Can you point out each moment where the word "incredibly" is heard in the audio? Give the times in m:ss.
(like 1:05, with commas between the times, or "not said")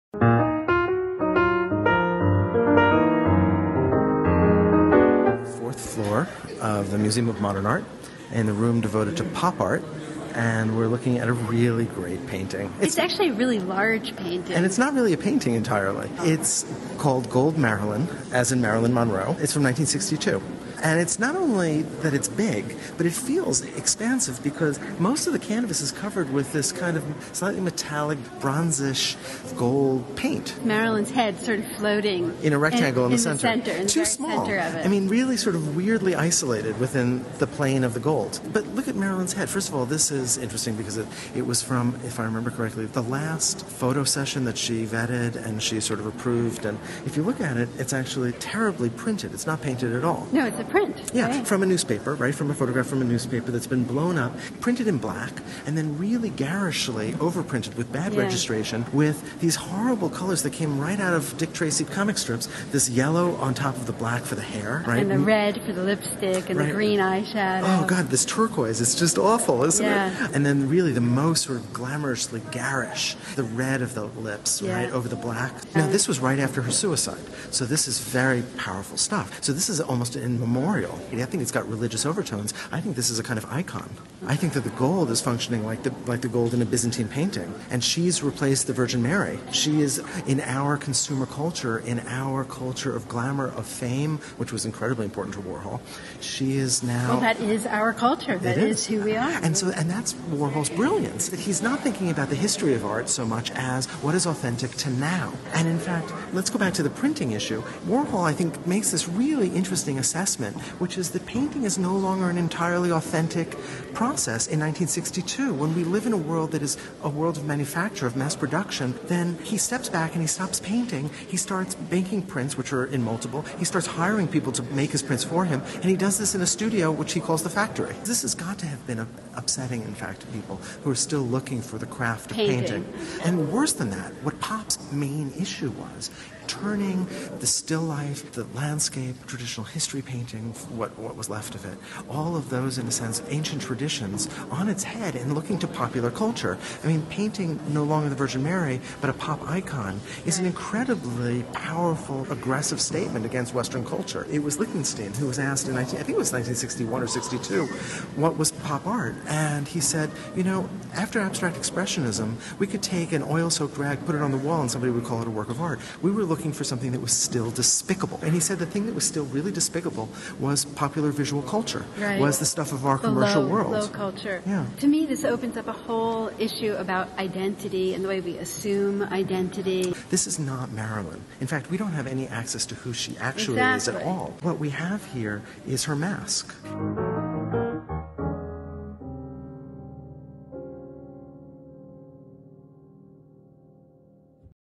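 1:34, 2:30.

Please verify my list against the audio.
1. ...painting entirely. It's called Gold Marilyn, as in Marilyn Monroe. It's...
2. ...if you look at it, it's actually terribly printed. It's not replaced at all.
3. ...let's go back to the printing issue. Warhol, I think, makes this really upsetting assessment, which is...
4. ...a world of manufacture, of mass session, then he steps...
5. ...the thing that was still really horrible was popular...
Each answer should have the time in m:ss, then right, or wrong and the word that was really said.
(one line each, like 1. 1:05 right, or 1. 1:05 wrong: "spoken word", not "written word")
1. 0:15 right
2. 0:47 wrong: "painted", not "replaced"
3. 1:46 wrong: "interesting", not "upsetting"
4. 1:57 wrong: "production", not "session"
5. 2:48 wrong: "despicable", not "horrible".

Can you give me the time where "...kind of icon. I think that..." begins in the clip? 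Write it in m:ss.
1:23.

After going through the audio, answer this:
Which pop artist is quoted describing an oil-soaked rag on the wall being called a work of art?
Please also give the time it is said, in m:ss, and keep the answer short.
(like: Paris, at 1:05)
Lichtenstein, at 2:34.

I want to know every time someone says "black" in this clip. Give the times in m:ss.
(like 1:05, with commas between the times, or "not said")
0:54, 1:03, 1:15.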